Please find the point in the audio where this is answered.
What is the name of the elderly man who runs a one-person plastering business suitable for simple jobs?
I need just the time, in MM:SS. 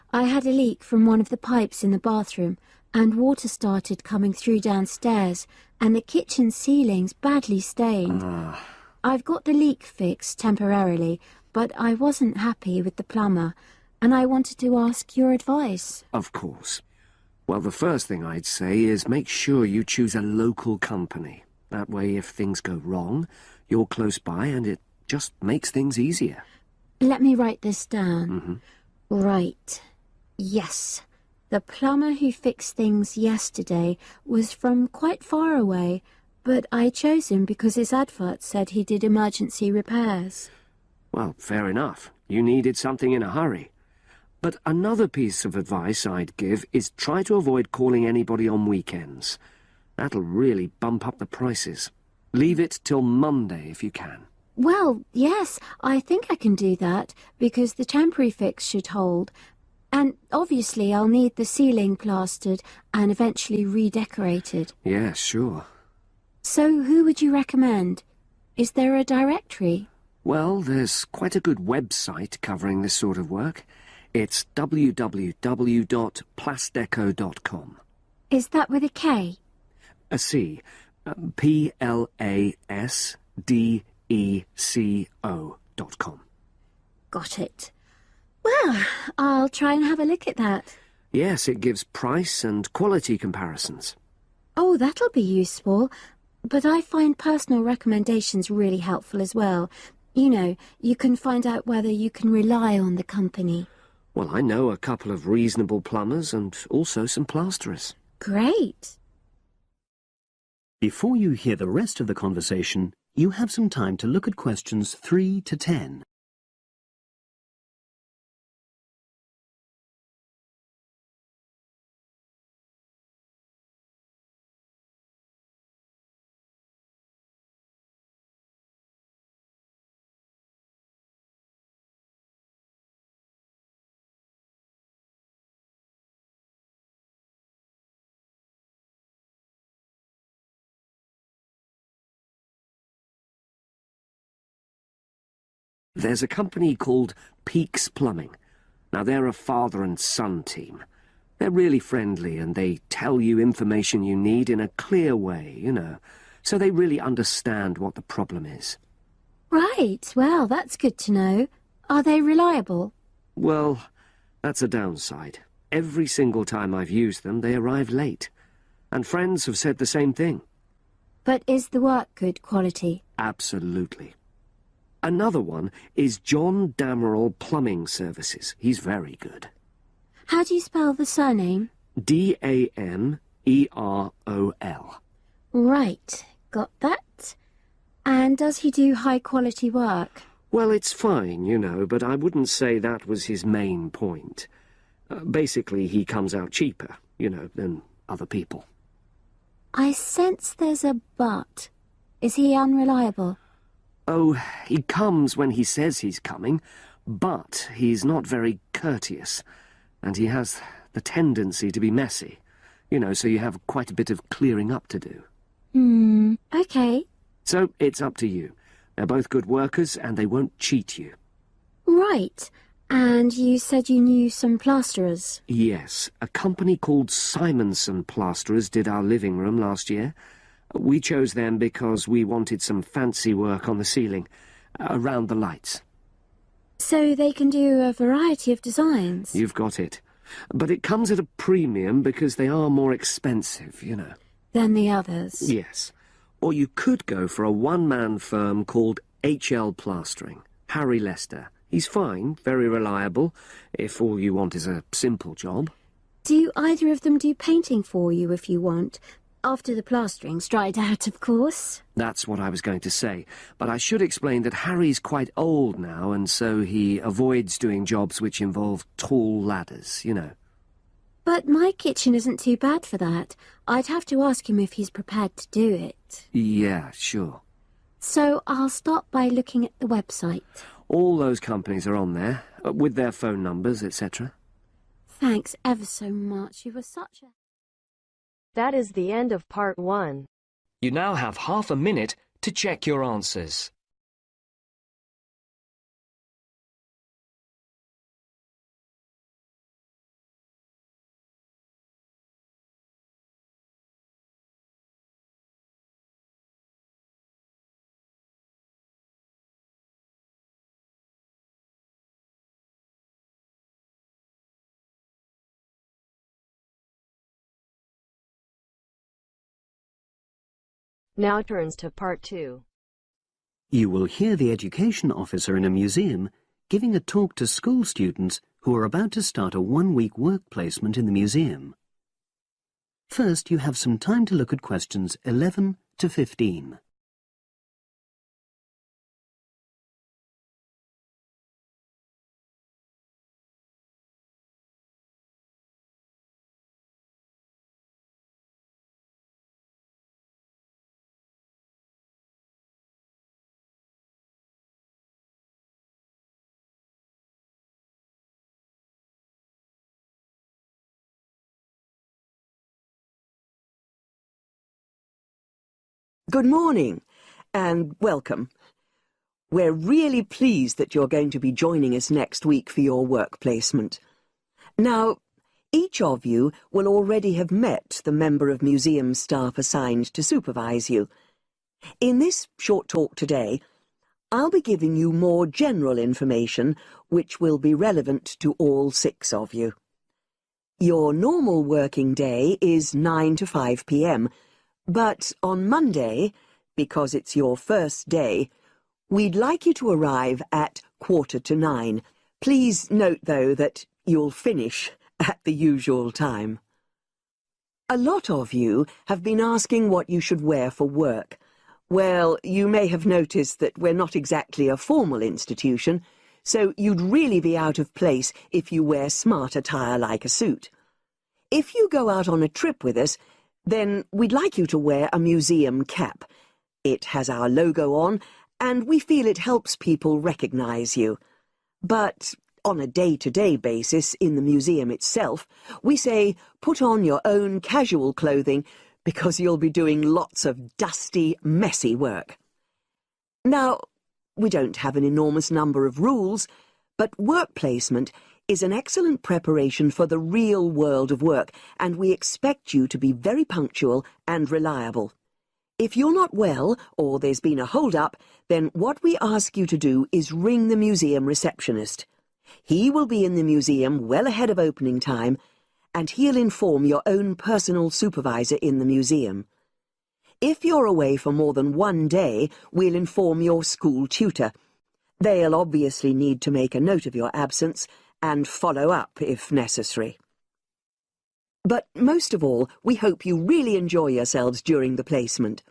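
04:10.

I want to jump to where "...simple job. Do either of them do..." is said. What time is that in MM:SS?
04:14.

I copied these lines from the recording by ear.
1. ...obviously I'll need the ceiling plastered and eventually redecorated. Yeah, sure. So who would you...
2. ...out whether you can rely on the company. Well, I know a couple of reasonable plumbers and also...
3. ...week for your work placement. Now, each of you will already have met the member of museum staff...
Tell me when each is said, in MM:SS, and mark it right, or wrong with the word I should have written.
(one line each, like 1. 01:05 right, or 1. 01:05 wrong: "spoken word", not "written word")
1. 01:00 right
2. 01:41 right
3. 06:12 right.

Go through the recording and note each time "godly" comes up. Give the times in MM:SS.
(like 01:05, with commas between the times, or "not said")
not said.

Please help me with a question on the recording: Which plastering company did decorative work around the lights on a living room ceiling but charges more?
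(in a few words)
Simonson Plasterers.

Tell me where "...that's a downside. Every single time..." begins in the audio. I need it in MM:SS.
02:44.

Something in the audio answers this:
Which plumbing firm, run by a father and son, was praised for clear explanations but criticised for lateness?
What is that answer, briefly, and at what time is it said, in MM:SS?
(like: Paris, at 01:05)
Peaks Plumbing, at 02:27.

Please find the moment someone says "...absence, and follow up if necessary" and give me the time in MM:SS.
07:57.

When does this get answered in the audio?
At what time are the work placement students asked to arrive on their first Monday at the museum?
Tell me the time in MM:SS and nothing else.
06:40.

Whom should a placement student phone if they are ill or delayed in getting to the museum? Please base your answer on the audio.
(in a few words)
museum receptionist.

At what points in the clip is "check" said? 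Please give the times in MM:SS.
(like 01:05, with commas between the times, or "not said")
04:52.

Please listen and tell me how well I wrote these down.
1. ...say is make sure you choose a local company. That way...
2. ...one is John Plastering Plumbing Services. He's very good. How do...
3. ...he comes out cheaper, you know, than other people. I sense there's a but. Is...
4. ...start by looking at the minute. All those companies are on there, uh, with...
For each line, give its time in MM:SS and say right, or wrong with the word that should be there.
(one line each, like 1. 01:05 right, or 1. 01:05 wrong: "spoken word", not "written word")
1. 00:18 right
2. 02:55 wrong: "Damerol", not "Plastering"
3. 03:15 right
4. 04:38 wrong: "website", not "minute".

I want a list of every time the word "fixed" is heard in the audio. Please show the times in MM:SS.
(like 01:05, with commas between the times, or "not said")
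00:09, 00:32.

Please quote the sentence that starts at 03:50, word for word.
We chose them because we wanted some fancy work on the ceiling, uh, around the lights.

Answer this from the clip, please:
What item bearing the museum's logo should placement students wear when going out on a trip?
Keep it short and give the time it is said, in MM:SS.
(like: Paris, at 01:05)
museum cap, at 07:05.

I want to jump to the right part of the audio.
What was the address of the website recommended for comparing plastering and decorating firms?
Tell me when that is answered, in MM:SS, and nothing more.
01:14.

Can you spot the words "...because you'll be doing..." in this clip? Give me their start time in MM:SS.
07:19.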